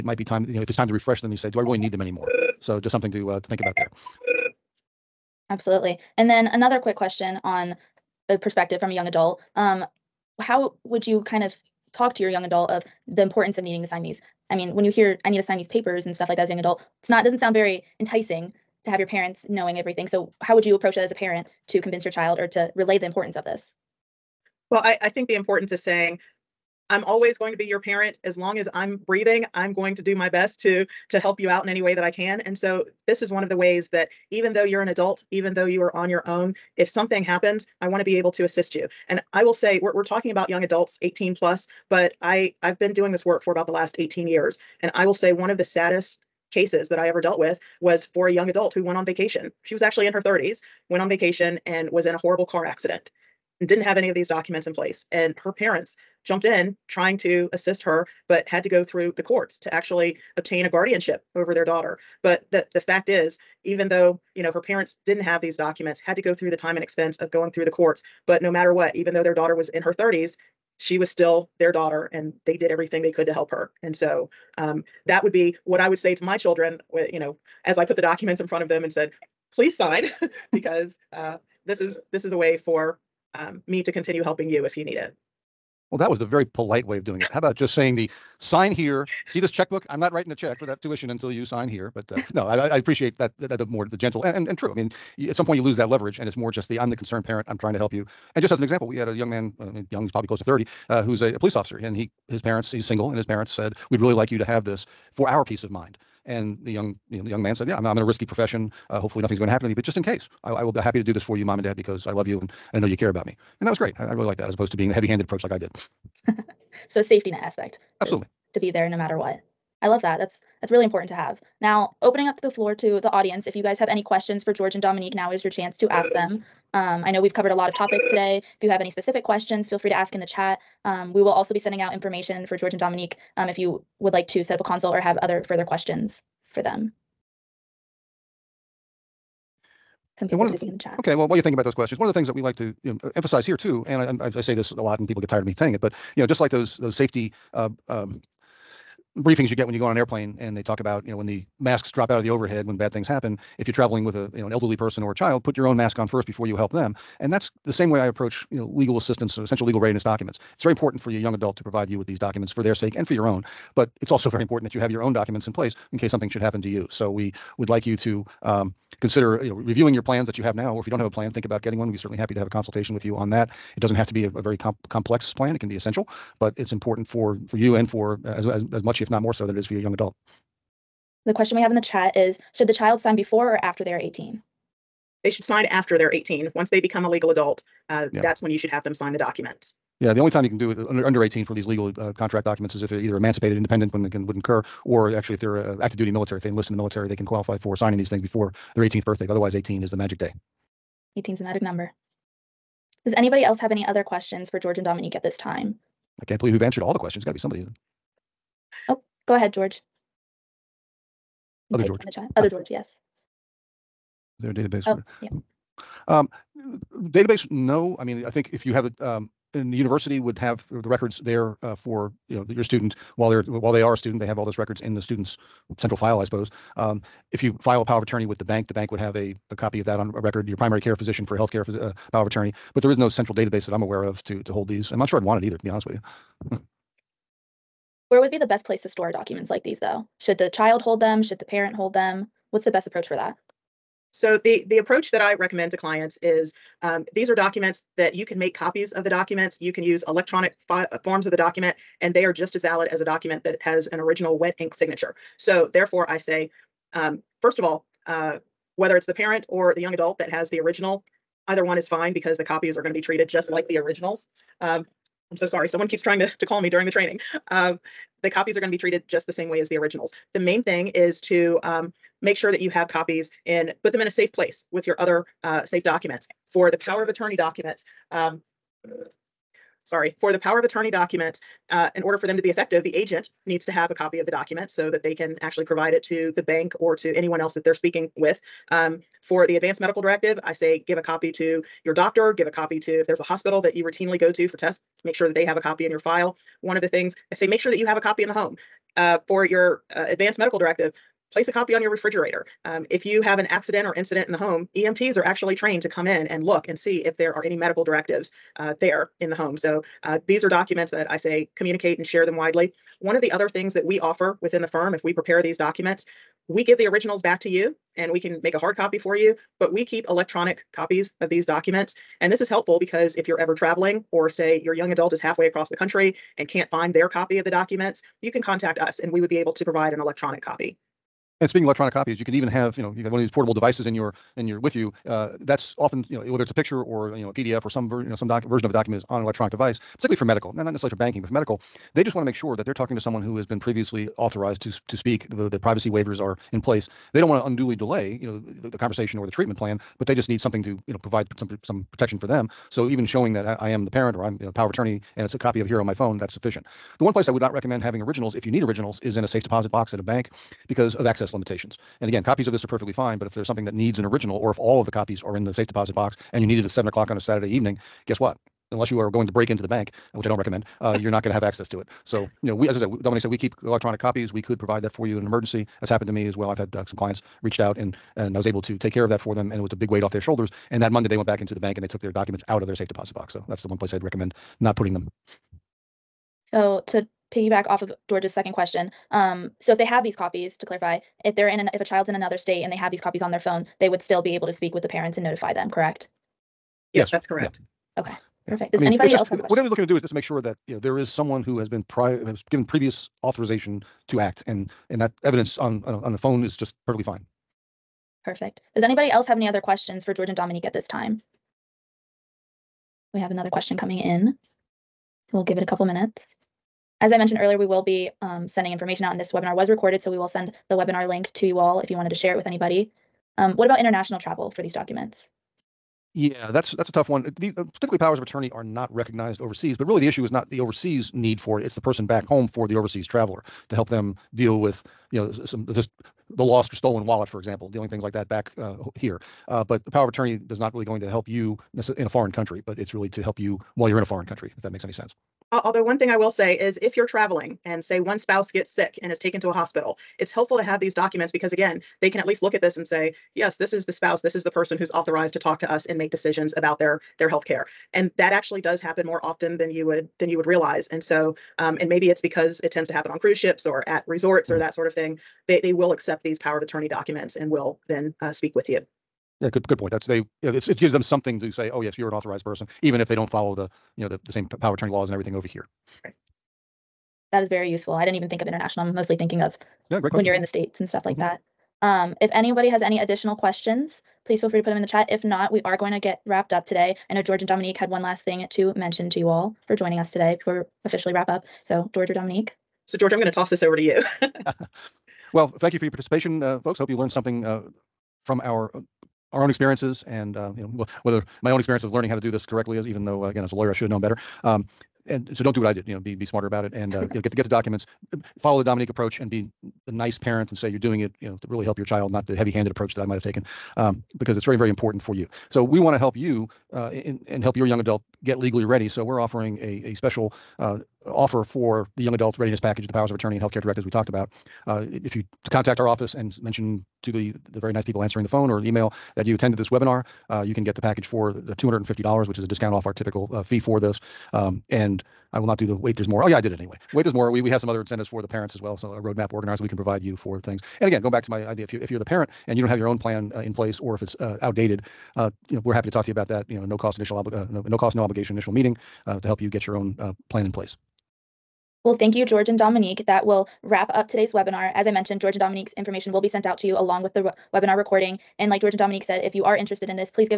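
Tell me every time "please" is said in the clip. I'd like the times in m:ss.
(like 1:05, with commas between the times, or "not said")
1:19, 8:04.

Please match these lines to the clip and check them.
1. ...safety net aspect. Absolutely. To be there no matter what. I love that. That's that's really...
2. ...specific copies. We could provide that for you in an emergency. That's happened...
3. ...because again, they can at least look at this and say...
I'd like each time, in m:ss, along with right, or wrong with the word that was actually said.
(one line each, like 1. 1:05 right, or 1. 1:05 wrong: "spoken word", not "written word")
1. 1:57 right
2. 6:13 wrong: "electronic", not "specific"
3. 7:31 right.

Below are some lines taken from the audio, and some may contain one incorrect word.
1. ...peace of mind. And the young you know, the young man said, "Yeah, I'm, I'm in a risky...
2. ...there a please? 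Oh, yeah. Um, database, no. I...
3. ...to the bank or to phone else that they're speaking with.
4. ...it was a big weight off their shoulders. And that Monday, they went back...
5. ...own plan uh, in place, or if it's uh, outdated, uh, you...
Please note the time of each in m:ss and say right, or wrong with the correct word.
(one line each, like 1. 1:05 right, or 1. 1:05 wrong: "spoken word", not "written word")
1. 1:45 right
2. 3:34 wrong: "database", not "please"
3. 4:46 wrong: "anyone", not "phone"
4. 6:19 right
5. 9:02 right.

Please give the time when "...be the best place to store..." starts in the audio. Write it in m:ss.
3:58.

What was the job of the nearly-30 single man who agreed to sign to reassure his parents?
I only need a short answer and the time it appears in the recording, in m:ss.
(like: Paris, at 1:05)
Police officer, at 1:41.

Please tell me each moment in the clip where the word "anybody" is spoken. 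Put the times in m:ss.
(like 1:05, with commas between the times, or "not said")
3:23, 6:38, 6:48, 7:02, 8:02.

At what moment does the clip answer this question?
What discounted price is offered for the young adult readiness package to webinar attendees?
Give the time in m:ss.
8:51.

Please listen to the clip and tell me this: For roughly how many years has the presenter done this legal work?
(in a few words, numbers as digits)
18 years.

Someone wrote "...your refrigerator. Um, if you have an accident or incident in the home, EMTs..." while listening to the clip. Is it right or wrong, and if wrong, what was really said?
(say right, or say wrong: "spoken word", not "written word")
right.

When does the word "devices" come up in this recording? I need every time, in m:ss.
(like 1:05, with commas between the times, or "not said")
5:33, 5:39.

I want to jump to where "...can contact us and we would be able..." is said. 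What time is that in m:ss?
5:28.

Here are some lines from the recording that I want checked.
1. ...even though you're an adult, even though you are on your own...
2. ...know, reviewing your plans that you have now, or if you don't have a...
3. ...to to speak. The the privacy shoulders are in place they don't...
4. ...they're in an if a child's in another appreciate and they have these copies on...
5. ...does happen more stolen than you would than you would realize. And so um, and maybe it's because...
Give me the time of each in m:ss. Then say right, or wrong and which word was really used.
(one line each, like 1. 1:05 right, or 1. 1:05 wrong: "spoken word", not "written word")
1. 0:34 right
2. 2:49 right
3. 5:44 wrong: "waivers", not "shoulders"
4. 6:31 wrong: "state", not "appreciate"
5. 7:38 wrong: "often", not "stolen".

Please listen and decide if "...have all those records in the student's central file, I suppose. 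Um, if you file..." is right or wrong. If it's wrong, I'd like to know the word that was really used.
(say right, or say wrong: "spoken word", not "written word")
right.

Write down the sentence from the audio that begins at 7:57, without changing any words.
I didn't even think of international.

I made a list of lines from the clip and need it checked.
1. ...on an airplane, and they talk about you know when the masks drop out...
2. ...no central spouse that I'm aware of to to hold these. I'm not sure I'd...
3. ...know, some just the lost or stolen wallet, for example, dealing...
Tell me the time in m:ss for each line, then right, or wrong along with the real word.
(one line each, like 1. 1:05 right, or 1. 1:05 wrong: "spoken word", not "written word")
1. 2:29 right
2. 3:52 wrong: "database", not "spouse"
3. 7:15 right.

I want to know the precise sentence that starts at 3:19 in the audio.
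But otherwise, 18 is the magic day.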